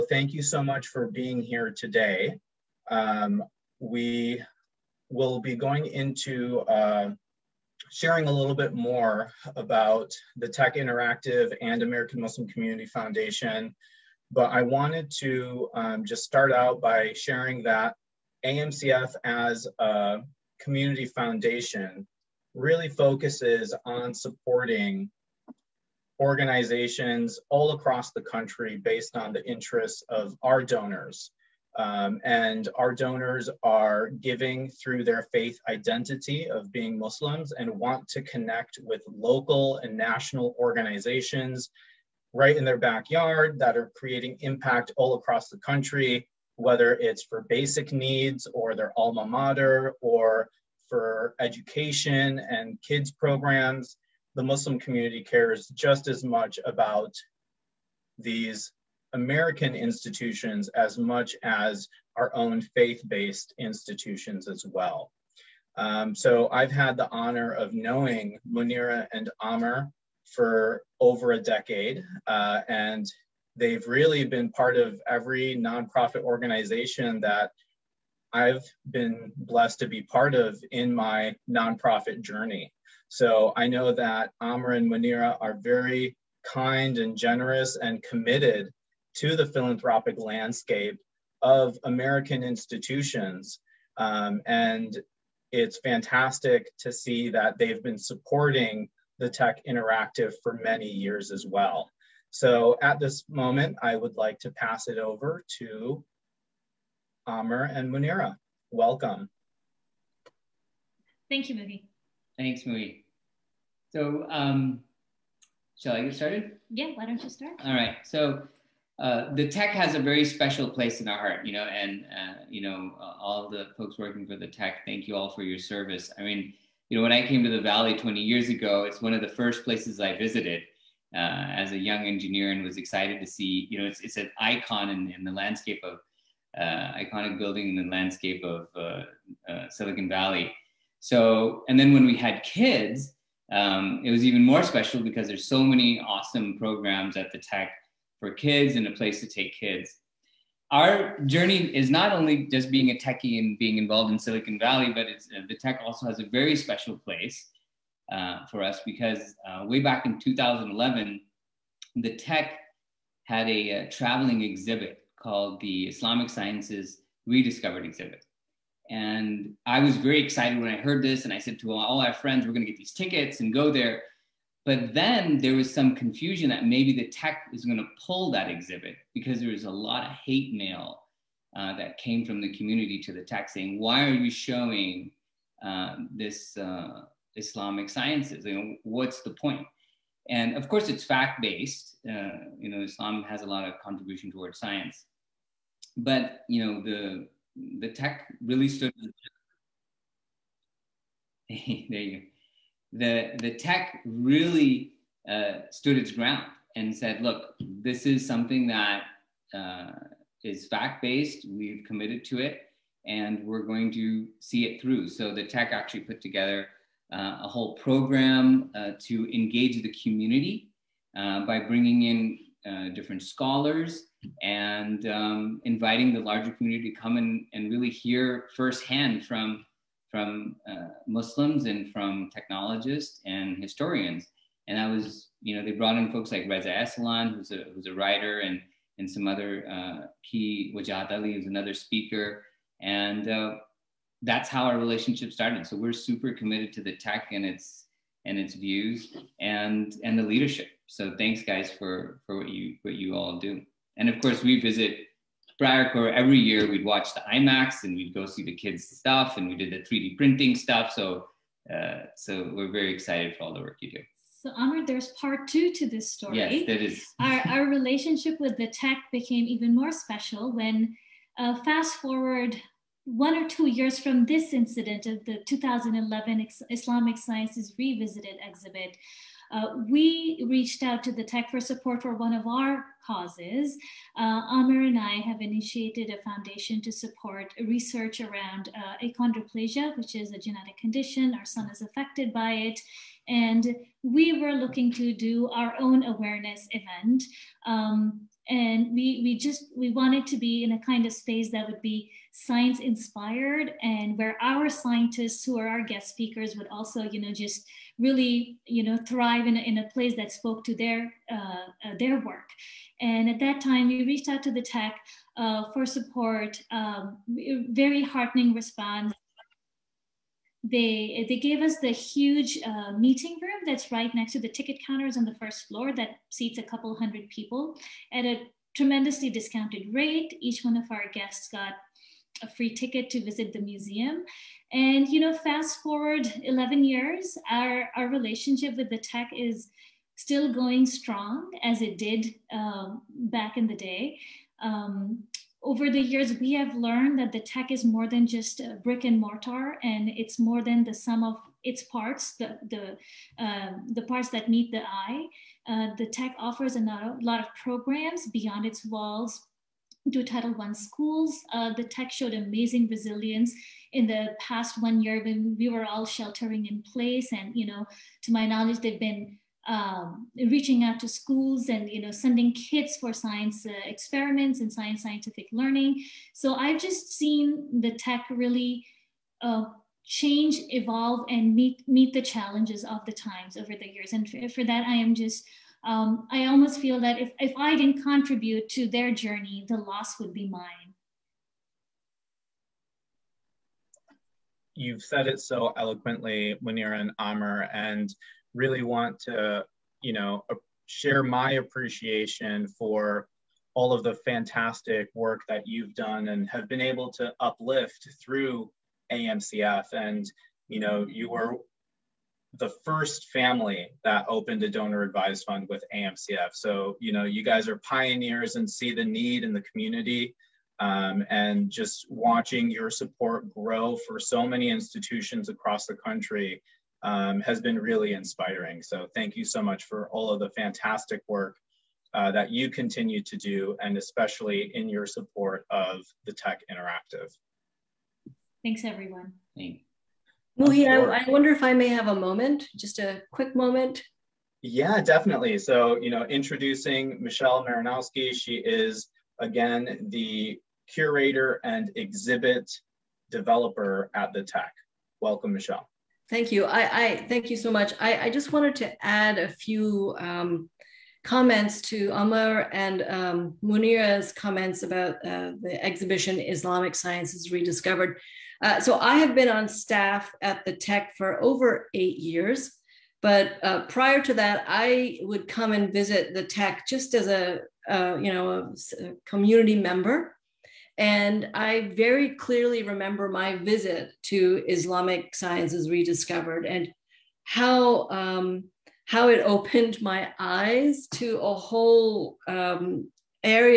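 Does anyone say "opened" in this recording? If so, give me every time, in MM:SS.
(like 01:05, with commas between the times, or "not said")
06:54, 08:09.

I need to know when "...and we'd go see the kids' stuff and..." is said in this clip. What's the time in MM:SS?
04:17.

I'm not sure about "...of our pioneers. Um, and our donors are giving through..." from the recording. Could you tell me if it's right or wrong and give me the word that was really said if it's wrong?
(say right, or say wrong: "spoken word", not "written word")
wrong: "donors", not "pioneers".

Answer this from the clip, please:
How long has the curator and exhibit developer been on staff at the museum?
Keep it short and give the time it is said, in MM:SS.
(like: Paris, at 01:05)
over 8 years, at 07:51.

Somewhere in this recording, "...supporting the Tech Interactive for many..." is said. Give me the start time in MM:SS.
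01:37.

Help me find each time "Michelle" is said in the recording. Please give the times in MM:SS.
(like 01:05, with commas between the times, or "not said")
07:27, 07:35.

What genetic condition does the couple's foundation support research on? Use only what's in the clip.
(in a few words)
achondroplasia.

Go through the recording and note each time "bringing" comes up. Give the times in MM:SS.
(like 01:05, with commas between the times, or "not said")
03:41.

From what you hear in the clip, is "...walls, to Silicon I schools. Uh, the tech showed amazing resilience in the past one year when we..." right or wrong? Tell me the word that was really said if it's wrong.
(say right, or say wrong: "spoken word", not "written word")
wrong: "Title", not "Silicon".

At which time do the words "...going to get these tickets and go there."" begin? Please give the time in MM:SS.
02:52.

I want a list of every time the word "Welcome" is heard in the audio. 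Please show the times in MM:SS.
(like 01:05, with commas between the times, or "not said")
01:48, 07:35.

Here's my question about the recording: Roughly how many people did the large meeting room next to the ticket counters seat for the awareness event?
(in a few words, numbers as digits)
a couple hundred.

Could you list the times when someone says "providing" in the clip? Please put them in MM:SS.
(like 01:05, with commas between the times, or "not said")
not said.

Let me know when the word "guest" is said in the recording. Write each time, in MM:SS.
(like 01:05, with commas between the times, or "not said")
05:05, 05:31.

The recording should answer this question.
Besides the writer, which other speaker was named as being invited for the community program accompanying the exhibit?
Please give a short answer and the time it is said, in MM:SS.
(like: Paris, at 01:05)
Wajahat Ali, at 04:00.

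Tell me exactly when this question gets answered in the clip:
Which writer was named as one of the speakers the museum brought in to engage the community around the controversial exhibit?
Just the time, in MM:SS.
03:56.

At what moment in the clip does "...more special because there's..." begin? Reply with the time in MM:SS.
02:24.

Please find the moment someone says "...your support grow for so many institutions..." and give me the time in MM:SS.
07:02.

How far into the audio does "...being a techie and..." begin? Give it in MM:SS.
02:32.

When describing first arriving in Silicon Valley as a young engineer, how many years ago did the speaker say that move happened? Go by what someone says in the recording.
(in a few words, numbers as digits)
20 years.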